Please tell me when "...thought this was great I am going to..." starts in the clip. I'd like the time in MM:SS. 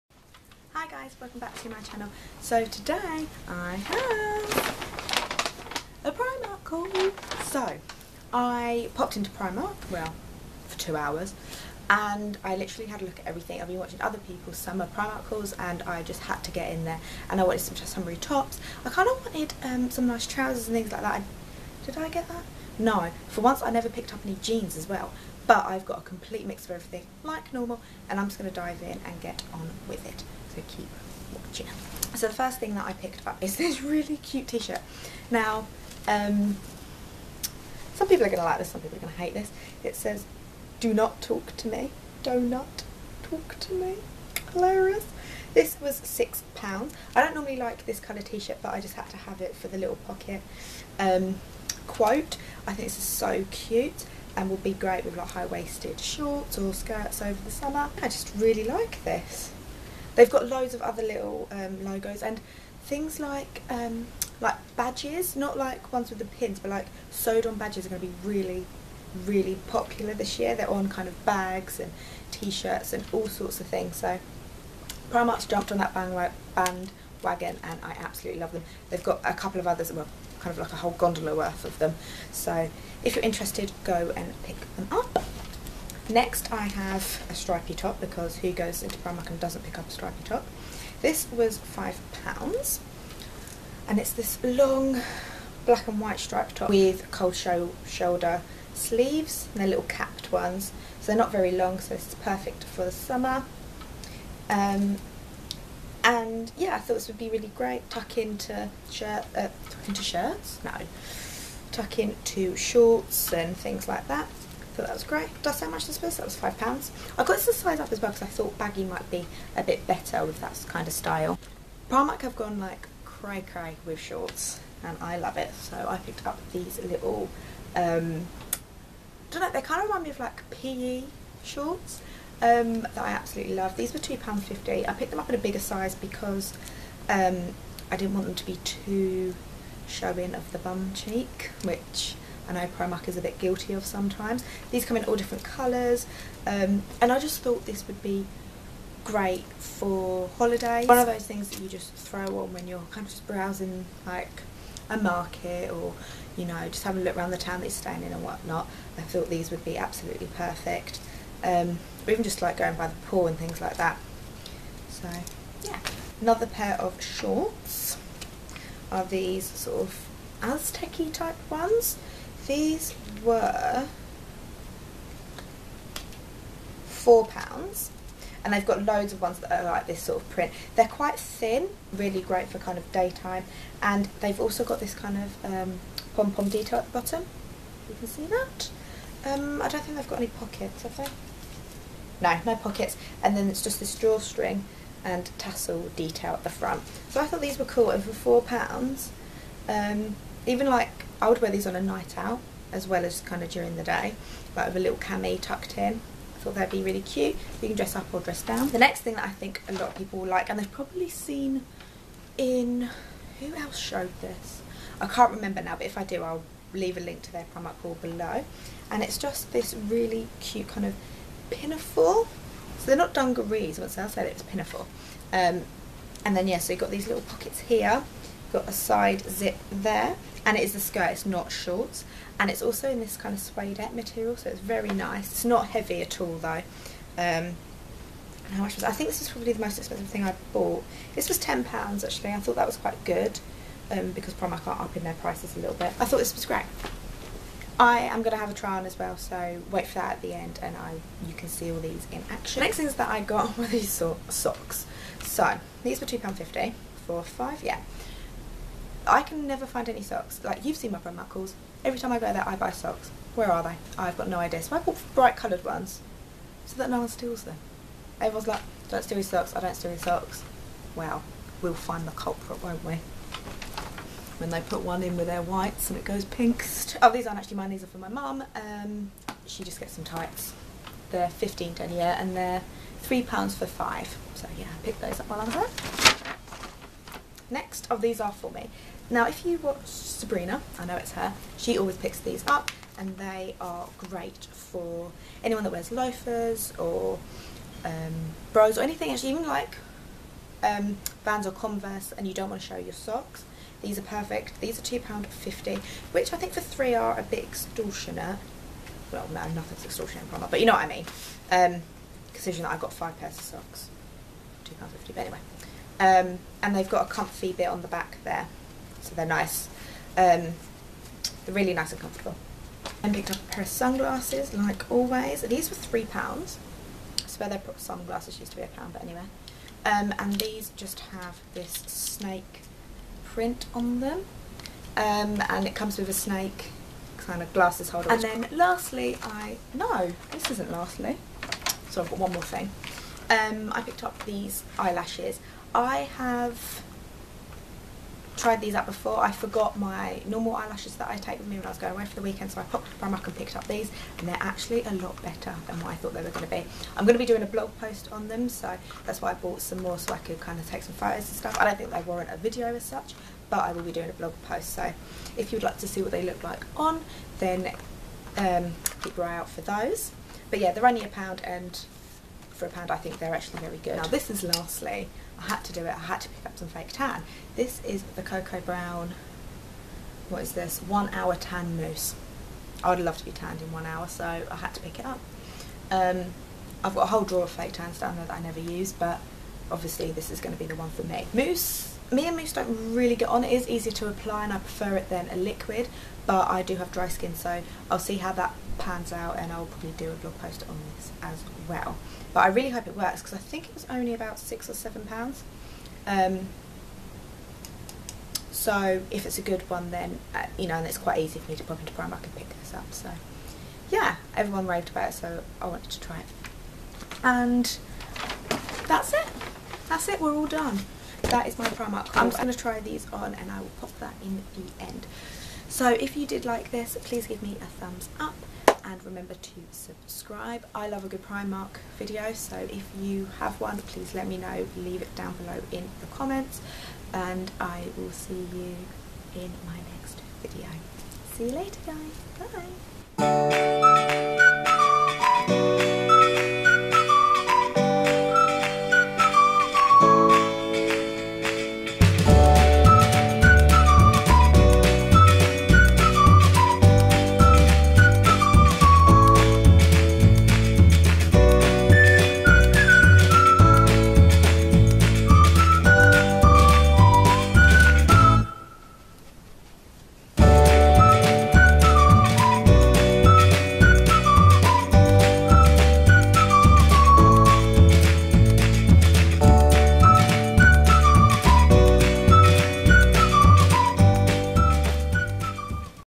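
04:06.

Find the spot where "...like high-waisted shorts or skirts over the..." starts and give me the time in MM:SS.
00:55.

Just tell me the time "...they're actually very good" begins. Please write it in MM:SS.
06:13.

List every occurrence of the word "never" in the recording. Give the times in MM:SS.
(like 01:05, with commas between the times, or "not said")
00:23, 04:19, 06:28.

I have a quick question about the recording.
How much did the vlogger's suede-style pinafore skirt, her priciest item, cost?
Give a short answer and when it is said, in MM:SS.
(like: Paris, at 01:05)
£10, at 04:01.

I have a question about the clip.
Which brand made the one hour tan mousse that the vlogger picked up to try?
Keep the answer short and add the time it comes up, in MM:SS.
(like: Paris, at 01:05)
Cocoa Brown, at 06:18.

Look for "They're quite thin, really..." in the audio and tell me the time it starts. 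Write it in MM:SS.
03:00.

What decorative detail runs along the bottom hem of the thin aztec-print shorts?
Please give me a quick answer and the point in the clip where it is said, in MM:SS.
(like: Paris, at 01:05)
Pom pom, at 03:06.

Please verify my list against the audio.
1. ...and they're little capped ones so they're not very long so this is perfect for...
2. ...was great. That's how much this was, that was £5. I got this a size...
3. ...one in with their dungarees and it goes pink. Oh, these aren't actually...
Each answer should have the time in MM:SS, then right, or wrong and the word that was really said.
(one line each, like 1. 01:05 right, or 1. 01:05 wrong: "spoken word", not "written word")
1. 01:39 right
2. 01:54 right
3. 04:34 wrong: "whites", not "dungarees".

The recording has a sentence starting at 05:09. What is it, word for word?
Well no, nothing's extortionate from but you know what I mean.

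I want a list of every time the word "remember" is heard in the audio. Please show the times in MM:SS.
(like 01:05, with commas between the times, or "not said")
03:35, 07:09.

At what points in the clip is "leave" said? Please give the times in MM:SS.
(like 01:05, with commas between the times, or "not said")
03:36, 07:14.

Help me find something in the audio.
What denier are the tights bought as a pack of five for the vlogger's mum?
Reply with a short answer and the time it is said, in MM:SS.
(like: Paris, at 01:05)
15, at 04:41.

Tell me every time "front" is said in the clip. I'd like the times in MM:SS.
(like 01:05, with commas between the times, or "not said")
03:16.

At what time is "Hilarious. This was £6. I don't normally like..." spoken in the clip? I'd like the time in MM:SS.
00:44.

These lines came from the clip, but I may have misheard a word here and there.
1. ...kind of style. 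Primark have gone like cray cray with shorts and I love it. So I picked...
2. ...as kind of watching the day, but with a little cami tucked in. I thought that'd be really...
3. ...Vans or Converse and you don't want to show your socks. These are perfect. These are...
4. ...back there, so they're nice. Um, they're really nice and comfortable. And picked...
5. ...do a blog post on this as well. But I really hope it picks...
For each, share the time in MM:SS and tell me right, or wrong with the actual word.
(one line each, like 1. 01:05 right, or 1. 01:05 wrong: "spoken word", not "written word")
1. 02:00 right
2. 03:23 wrong: "during", not "watching"
3. 05:01 right
4. 05:17 right
5. 06:39 wrong: "works", not "picks".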